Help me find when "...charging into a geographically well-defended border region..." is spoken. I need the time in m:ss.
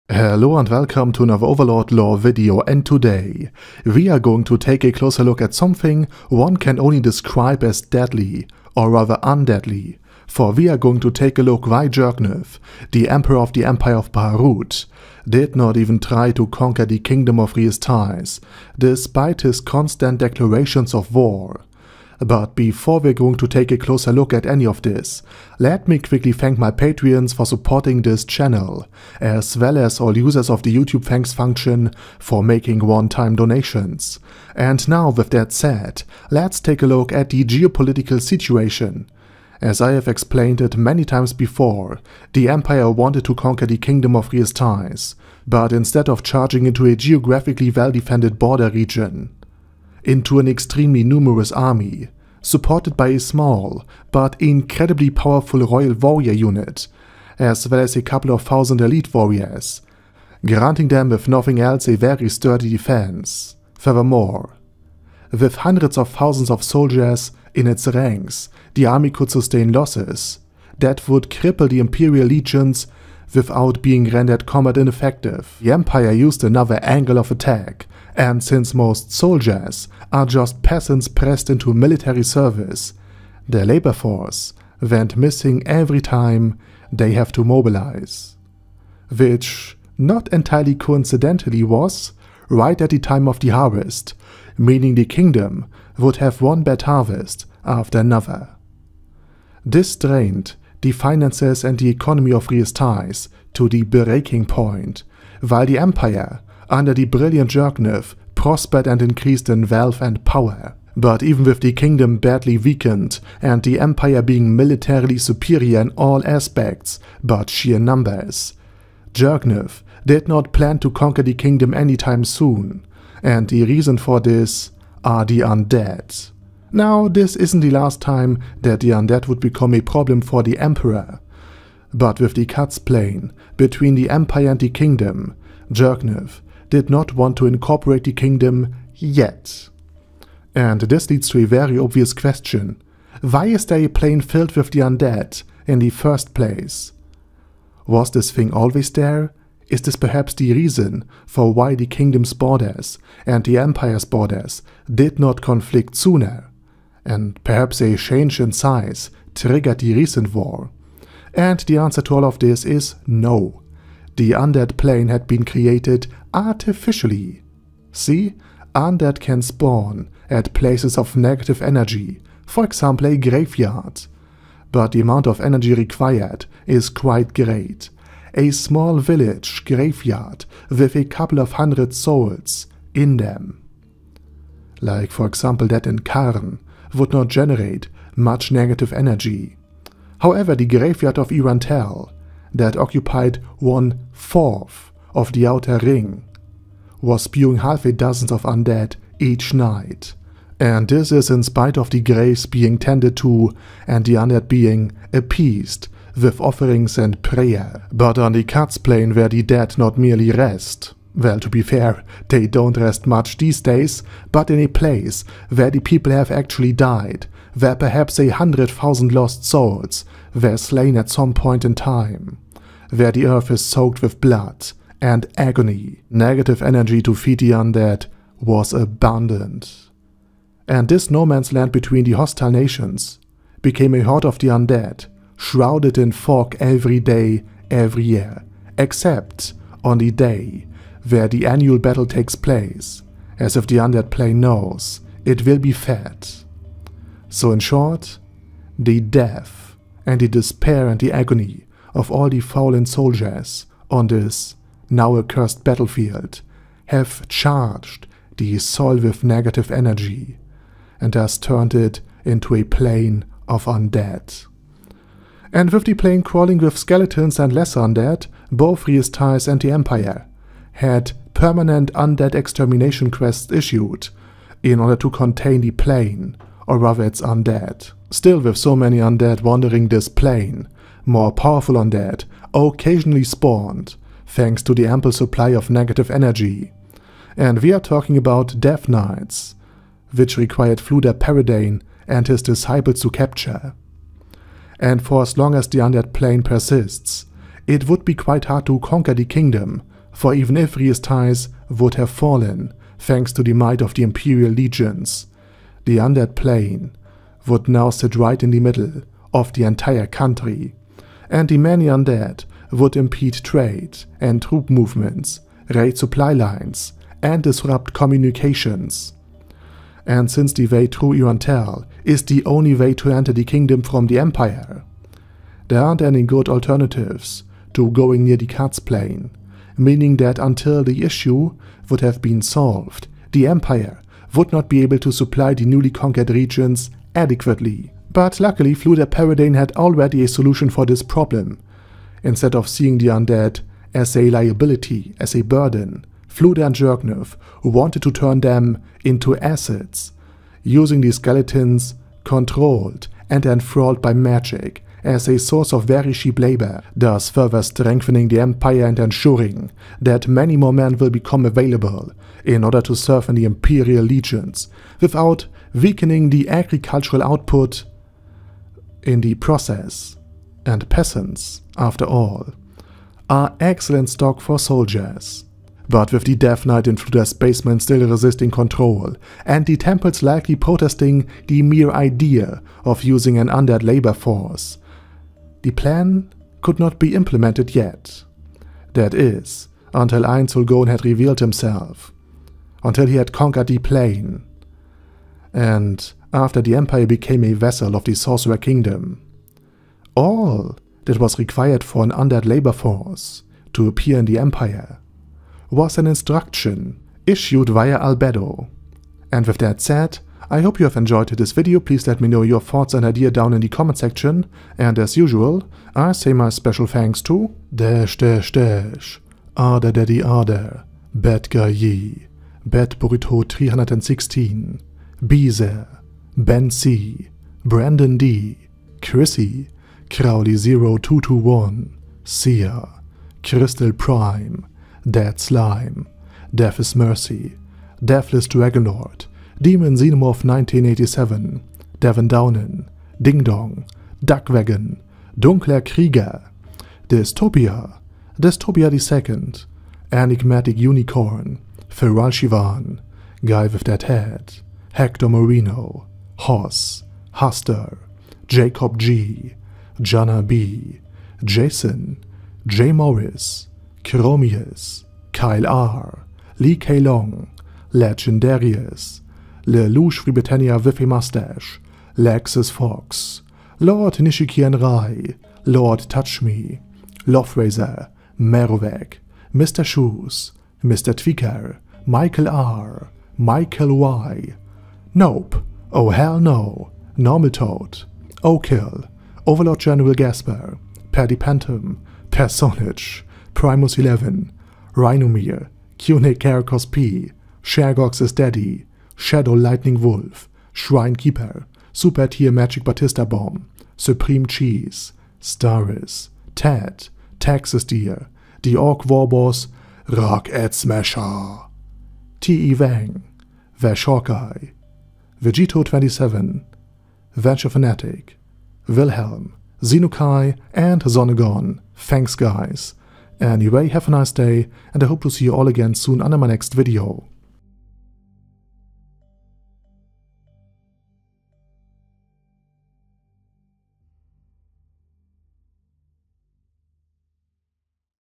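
0:46.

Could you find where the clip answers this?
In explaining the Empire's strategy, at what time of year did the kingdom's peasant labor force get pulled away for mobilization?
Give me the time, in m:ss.
1:33.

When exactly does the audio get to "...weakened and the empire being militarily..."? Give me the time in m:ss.
1:52.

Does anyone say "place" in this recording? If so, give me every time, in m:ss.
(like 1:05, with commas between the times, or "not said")
2:26, 2:50, 3:34, 4:02.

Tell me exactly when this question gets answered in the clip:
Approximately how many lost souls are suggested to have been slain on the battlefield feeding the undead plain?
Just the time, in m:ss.
3:38.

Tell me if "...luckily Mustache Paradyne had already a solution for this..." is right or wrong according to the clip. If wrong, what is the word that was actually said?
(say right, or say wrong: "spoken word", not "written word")
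wrong: "Fluder", not "Mustache".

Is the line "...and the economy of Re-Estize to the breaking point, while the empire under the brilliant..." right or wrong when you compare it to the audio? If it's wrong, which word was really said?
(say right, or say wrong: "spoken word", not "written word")
right.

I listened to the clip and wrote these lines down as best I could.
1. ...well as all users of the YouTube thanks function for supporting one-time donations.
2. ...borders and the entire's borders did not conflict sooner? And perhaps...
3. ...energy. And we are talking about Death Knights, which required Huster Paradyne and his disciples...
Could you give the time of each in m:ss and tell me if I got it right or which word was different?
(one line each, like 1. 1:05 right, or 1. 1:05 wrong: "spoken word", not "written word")
1. 0:29 wrong: "making", not "supporting"
2. 2:32 wrong: "empire", not "entire"
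3. 4:46 wrong: "Fluder", not "Huster".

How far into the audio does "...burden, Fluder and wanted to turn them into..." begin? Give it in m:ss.
5:45.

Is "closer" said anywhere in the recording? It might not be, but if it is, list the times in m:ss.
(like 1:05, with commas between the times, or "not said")
0:04, 0:23.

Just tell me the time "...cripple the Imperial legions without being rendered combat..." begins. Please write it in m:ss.
1:11.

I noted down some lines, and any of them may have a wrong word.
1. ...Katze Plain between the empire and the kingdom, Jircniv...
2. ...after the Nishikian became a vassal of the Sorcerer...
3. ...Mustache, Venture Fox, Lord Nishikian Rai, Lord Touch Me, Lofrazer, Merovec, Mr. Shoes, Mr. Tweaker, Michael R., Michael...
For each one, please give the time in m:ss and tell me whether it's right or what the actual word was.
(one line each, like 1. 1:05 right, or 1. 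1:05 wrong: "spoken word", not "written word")
1. 2:12 right
2. 6:36 wrong: "Empire", not "Nishikian"
3. 7:51 wrong: "Lexus", not "Venture".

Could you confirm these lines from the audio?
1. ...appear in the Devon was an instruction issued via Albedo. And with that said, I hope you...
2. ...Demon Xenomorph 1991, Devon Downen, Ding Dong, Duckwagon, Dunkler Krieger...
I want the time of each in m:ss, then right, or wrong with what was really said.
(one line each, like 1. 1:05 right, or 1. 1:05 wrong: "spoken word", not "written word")
1. 6:43 wrong: "Empire", not "Devon"
2. 7:19 wrong: "1987", not "1991".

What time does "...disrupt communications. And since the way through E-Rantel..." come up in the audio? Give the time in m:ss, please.
5:17.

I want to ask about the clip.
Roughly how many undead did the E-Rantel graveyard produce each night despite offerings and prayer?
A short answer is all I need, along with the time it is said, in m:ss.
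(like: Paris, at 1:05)
Half a dozen, at 3:17.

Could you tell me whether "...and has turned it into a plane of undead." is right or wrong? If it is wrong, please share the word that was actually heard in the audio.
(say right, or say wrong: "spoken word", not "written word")
right.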